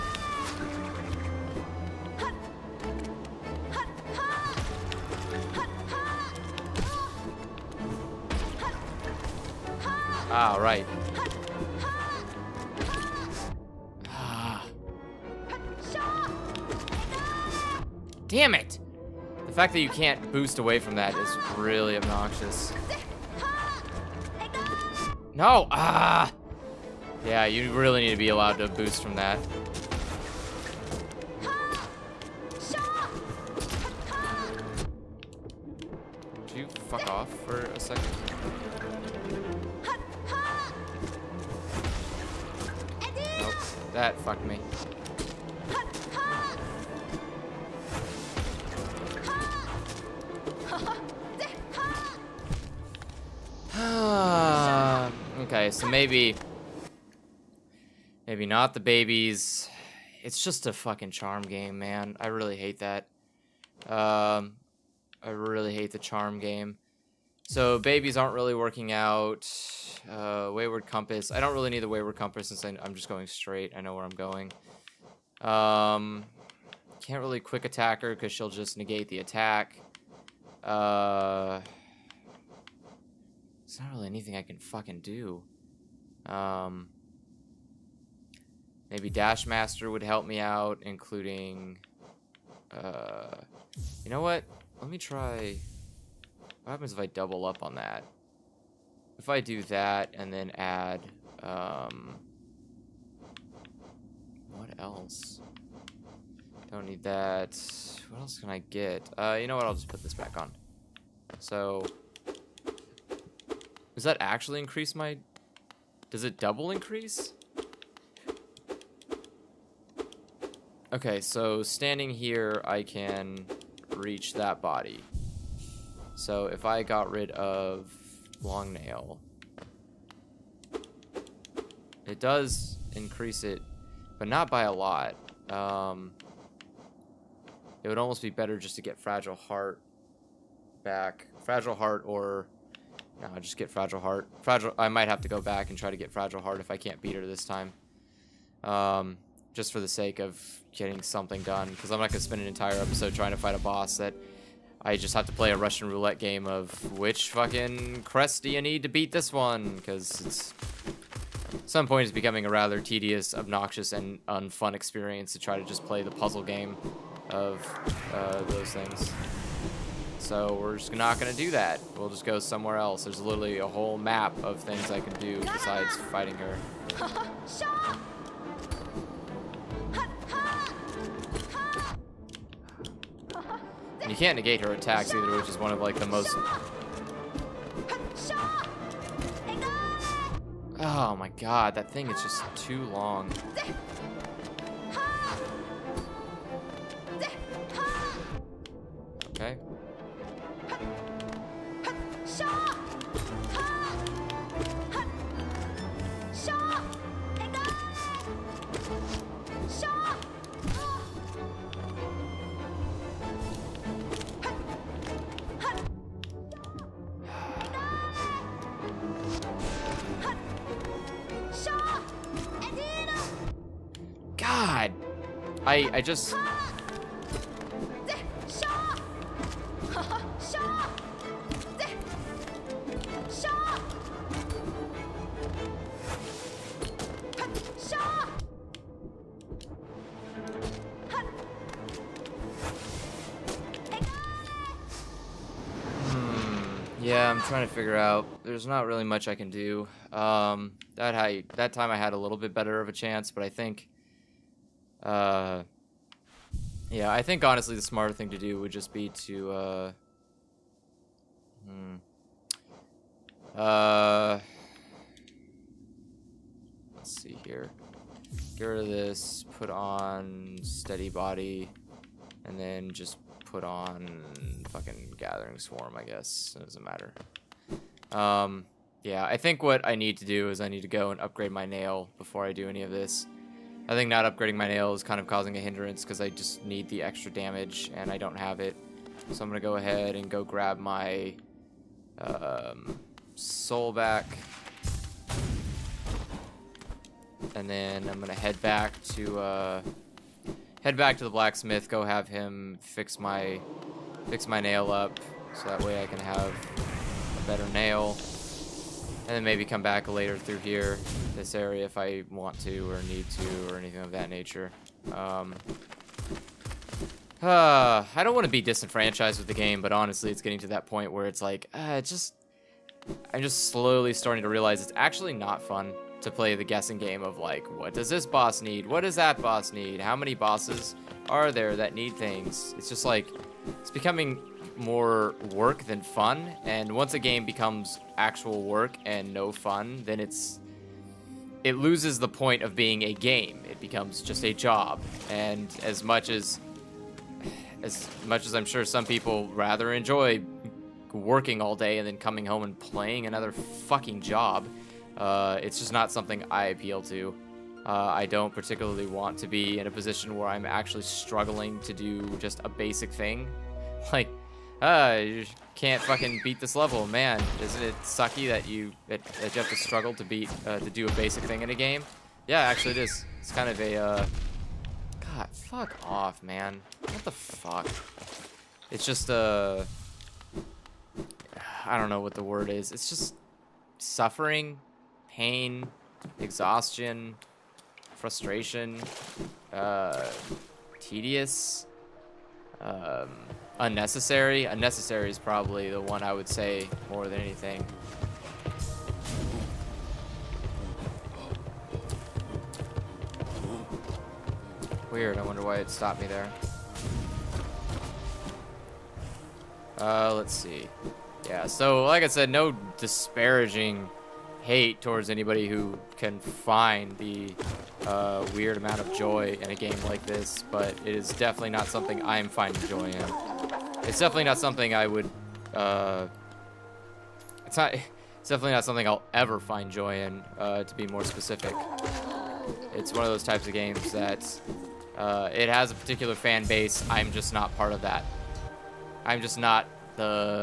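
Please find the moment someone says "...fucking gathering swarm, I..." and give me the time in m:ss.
4:34.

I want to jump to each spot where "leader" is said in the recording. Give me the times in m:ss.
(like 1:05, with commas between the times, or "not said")
not said.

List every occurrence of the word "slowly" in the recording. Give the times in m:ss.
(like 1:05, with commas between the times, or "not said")
5:23.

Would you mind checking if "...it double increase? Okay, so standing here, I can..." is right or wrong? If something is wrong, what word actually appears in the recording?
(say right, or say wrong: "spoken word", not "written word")
right.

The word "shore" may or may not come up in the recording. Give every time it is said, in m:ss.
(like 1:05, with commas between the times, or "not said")
not said.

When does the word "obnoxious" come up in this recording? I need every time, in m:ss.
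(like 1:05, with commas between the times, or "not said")
0:21, 2:43.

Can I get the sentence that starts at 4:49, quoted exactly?
So I'm going to go ahead and go grab my um, soul back.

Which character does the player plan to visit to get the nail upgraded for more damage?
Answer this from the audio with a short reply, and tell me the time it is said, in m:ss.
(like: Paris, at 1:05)
the blacksmith, at 5:01.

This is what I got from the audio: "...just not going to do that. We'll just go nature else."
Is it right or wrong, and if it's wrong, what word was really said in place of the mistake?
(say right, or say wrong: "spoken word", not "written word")
wrong: "somewhere", not "nature".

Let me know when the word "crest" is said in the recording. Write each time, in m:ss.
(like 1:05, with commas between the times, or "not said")
2:38.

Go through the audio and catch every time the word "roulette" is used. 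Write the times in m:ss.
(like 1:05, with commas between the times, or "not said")
2:35.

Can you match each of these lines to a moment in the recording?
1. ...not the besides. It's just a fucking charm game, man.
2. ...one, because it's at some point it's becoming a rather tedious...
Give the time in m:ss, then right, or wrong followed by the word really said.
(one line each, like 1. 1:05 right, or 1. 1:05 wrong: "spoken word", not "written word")
1. 0:58 wrong: "babies", not "besides"
2. 2:39 right.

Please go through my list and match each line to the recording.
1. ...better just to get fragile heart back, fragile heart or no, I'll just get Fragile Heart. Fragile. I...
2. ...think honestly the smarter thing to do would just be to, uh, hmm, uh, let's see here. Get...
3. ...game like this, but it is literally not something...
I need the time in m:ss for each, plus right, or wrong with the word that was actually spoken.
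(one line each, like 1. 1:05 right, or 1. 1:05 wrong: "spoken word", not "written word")
1. 2:18 right
2. 4:17 right
3. 6:59 wrong: "definitely", not "literally".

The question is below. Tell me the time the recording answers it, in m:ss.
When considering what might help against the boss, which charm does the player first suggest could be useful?
1:29.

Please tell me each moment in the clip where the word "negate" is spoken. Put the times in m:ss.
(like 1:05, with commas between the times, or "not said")
1:18, 3:04.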